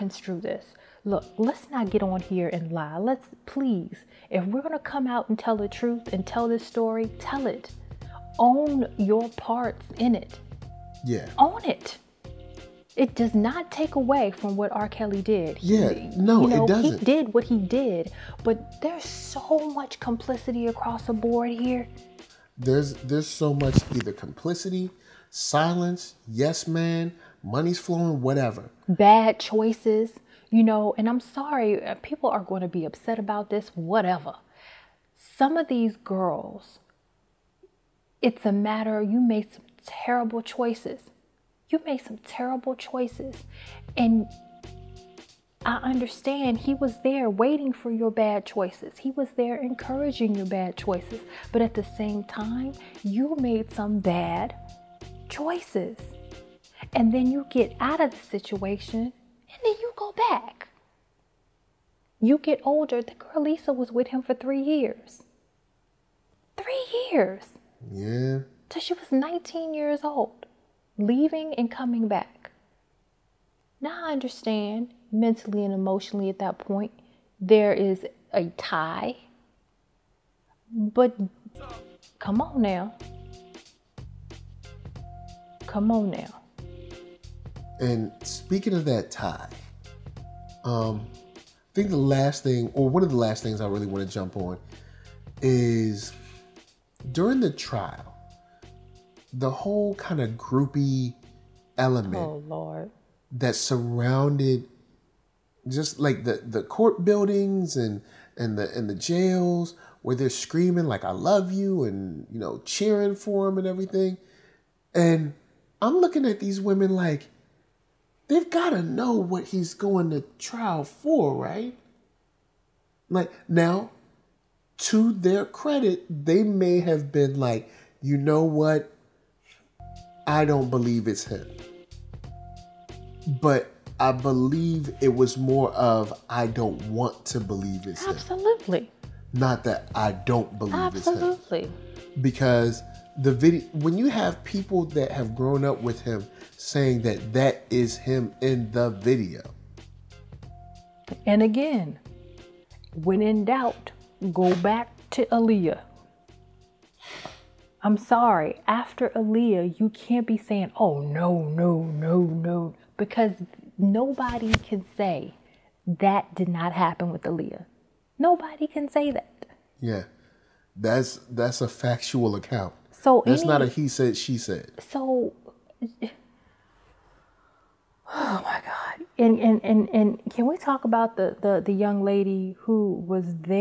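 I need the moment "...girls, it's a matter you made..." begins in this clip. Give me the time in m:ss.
0:35.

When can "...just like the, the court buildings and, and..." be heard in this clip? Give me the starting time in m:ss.
1:45.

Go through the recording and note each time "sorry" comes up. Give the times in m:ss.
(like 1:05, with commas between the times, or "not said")
0:31, 2:37.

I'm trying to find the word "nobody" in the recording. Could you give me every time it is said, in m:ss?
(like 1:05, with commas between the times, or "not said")
2:43, 2:48.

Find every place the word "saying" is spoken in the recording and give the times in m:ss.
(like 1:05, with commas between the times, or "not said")
2:26, 2:40.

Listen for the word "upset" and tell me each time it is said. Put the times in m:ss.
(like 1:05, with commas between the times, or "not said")
0:32.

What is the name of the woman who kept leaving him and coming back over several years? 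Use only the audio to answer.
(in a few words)
Lisa.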